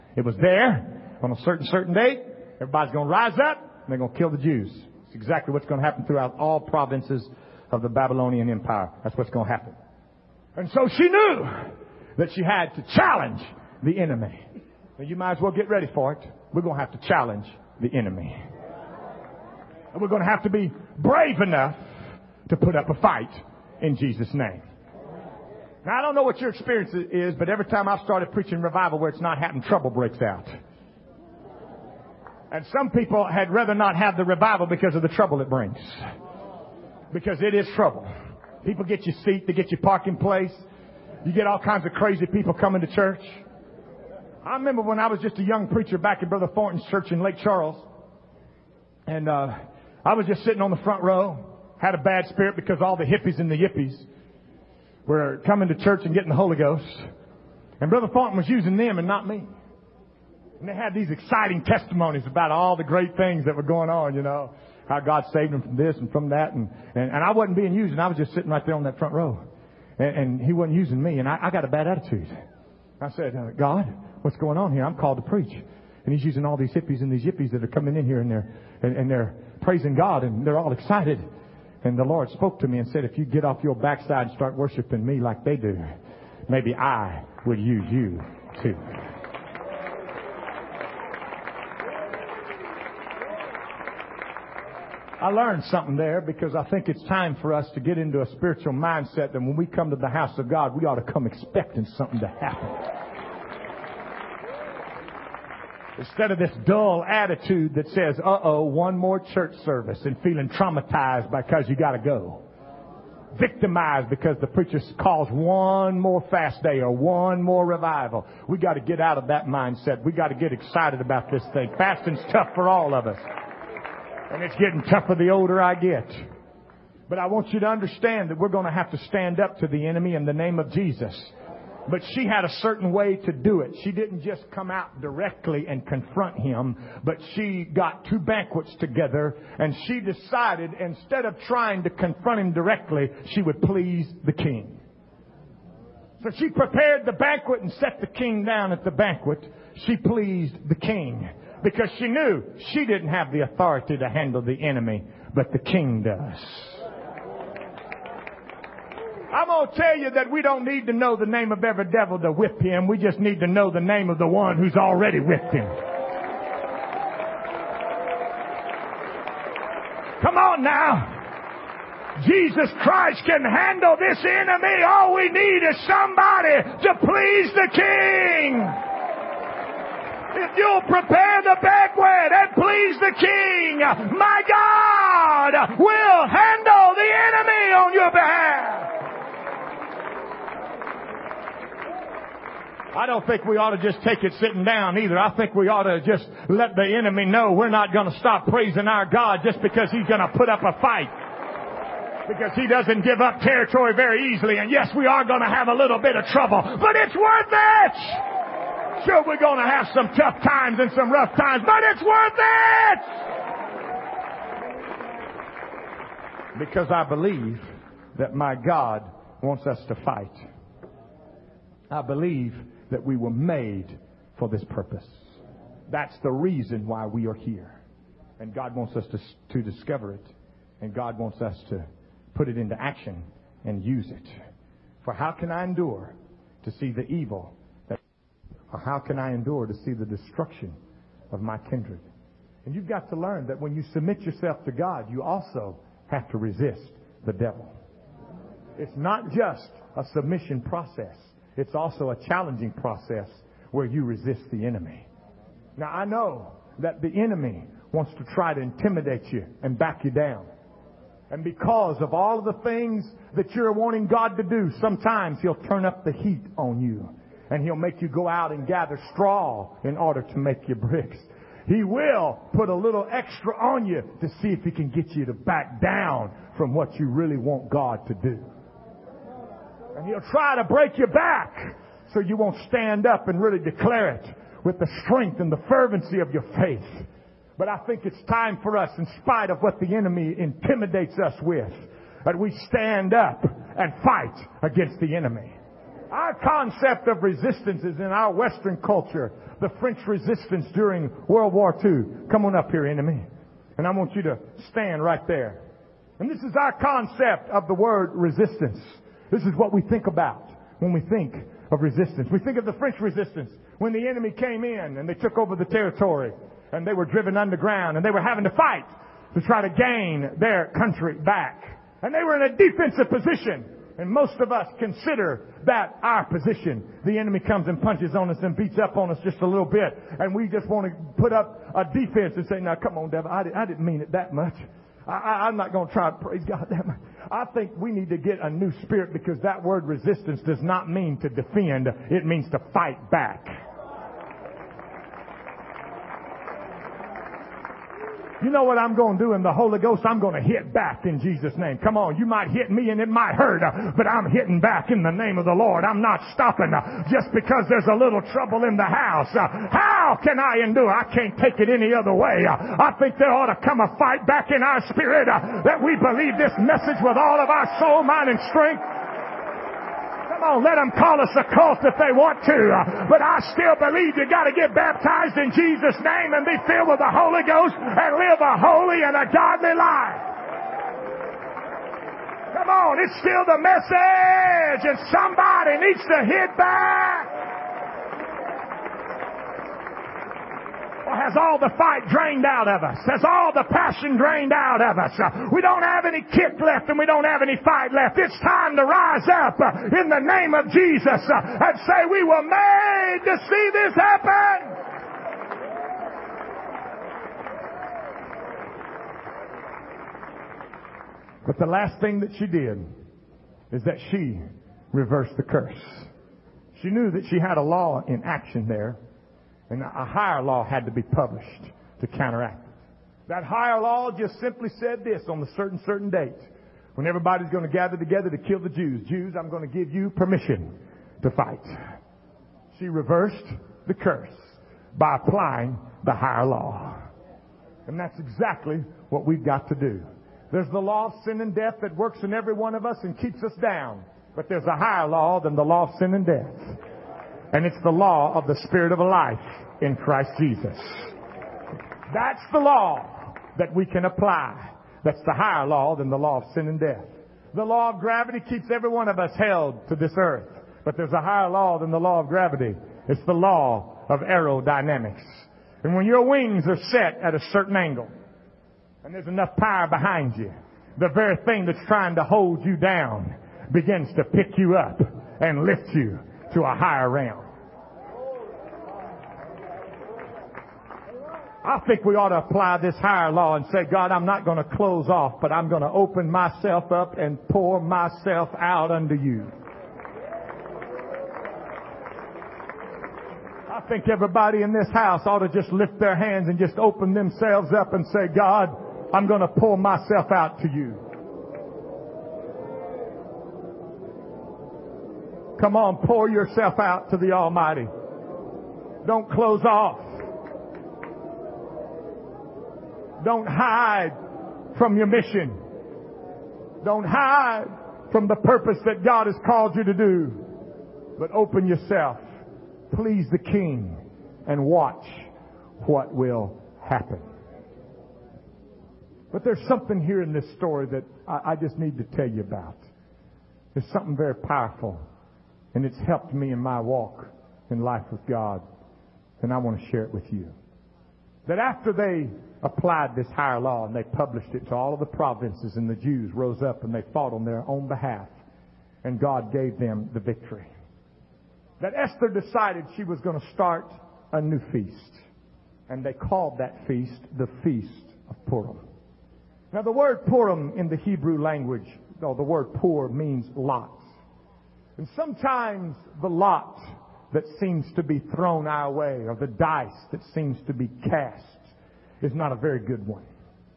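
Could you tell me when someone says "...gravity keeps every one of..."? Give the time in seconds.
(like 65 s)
457 s.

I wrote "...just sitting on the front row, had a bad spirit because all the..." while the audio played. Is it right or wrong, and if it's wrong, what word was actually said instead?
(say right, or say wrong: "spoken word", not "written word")
right.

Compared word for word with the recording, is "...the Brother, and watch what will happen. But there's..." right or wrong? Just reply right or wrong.
wrong.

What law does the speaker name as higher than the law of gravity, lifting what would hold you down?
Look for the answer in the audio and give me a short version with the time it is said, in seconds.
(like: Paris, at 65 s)
law of aerodynamics, at 463 s.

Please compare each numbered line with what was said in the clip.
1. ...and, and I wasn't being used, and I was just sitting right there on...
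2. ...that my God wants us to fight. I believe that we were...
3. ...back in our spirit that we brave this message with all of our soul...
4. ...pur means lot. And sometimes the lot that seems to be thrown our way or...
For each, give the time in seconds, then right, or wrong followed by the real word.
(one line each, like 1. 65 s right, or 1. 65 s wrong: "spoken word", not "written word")
1. 66 s right
2. 218 s right
3. 364 s wrong: "believe", not "brave"
4. 562 s right.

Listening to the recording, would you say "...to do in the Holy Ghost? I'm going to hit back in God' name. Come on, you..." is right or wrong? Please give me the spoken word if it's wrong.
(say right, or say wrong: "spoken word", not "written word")
wrong: "Jesus", not "God".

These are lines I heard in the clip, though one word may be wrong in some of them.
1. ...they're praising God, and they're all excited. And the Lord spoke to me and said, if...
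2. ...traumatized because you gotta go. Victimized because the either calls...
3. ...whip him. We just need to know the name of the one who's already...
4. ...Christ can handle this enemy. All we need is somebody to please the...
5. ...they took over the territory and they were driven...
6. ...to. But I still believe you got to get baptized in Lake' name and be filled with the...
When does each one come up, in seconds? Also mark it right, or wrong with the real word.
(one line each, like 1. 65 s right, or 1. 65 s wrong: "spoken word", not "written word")
1. 79 s right
2. 110 s wrong: "preacher", not "either"
3. 162 s right
4. 172 s right
5. 315 s right
6. 372 s wrong: "Jesus", not "Lake".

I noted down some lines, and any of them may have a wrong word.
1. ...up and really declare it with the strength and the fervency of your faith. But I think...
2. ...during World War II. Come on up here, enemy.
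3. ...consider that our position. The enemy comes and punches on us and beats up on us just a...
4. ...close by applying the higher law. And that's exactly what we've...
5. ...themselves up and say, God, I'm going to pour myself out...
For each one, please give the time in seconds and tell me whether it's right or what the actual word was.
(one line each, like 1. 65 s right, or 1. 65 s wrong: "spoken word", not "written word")
1. 283 s right
2. 300 s right
3. 324 s right
4. 433 s wrong: "curse", not "close"
5. 497 s right.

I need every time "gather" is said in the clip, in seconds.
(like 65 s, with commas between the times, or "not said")
268 s, 427 s.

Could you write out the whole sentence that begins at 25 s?
Now I don't know what your experience is, but every time I've started preaching revival where it's not happening, trouble breaks out.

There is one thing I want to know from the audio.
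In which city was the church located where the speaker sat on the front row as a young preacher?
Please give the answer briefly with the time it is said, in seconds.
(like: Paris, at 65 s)
Lake Charles, at 47 s.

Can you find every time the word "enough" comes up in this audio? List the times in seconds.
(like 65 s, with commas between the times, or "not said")
21 s, 469 s.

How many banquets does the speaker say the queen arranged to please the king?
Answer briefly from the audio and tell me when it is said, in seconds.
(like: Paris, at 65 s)
2, at 138 s.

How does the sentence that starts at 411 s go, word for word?
But the last thing that she did is that she reversed the curse.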